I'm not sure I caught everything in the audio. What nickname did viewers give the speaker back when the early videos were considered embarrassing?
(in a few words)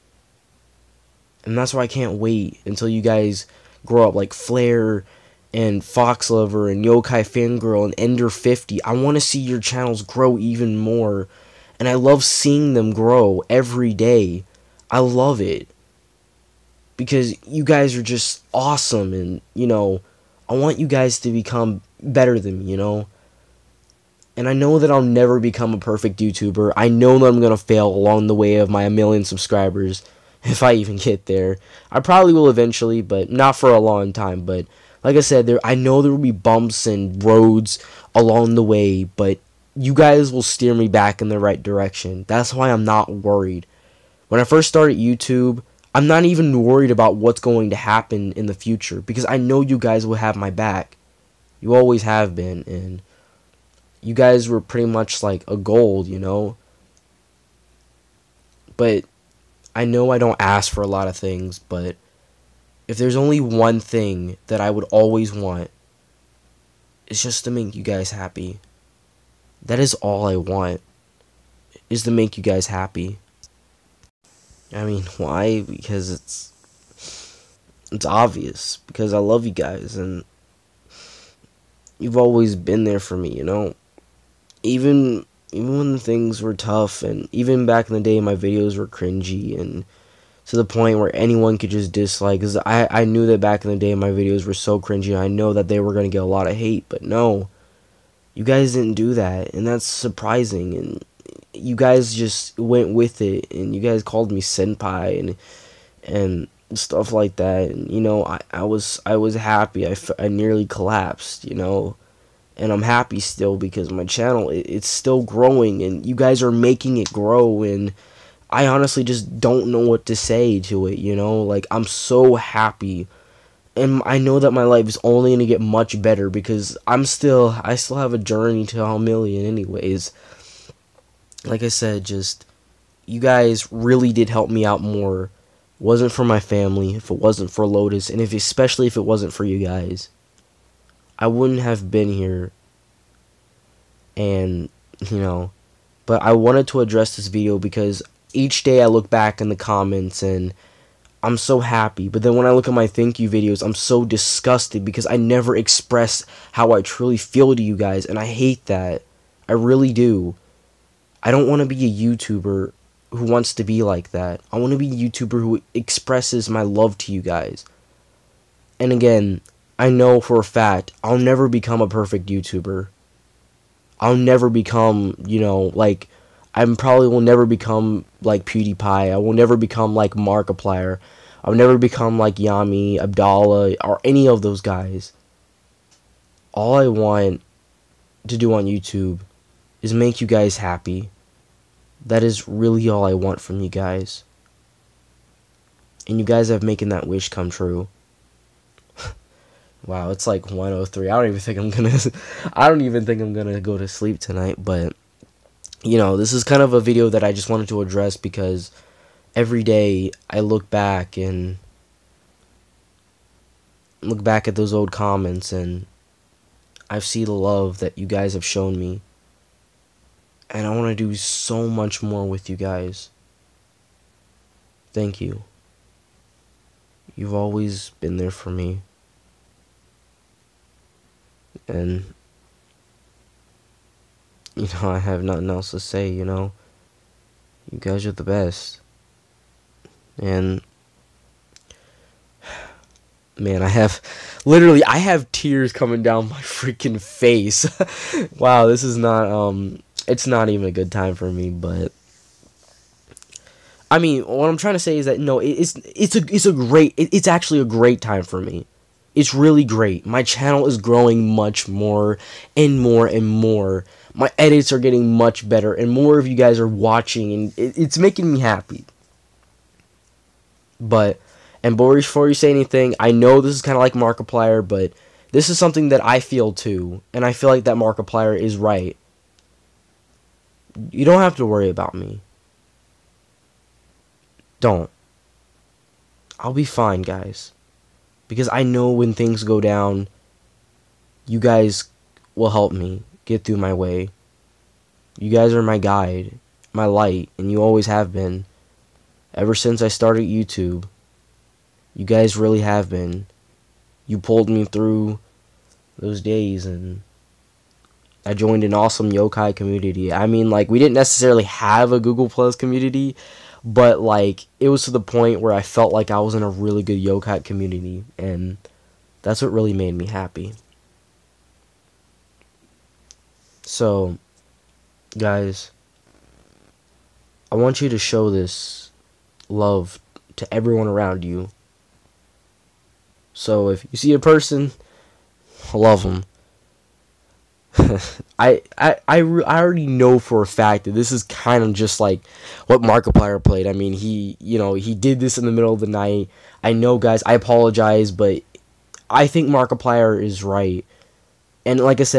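senpai.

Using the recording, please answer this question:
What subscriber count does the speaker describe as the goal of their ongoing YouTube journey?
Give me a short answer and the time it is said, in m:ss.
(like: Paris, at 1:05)
a million, at 2:08.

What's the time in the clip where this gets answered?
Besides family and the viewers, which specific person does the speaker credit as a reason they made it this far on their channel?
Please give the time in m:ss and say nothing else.
2:17.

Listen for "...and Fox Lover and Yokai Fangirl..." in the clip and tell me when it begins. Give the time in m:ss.
0:05.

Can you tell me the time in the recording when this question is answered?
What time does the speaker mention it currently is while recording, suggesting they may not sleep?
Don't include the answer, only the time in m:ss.
3:20.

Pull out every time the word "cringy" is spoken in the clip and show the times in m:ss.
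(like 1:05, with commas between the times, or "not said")
1:28, 1:34.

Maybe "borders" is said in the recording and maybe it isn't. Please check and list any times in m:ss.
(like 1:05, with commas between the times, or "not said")
not said.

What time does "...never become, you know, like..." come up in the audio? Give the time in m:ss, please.
2:54.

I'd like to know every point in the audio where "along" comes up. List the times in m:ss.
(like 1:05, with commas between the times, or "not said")
0:27, 0:38.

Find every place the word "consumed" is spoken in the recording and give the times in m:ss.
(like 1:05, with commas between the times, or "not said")
not said.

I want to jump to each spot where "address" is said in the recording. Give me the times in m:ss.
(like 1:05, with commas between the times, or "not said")
2:26, 3:27.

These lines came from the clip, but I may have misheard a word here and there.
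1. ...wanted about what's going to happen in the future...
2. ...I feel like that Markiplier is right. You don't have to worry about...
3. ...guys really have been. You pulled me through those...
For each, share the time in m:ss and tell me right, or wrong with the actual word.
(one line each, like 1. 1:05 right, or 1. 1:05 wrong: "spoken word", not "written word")
1. 0:46 wrong: "worried", not "wanted"
2. 4:37 right
3. 5:02 right.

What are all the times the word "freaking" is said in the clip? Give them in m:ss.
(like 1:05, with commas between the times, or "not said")
4:06.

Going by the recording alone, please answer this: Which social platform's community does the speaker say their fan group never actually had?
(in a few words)
Google Plus.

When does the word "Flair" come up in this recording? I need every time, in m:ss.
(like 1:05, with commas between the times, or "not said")
0:04.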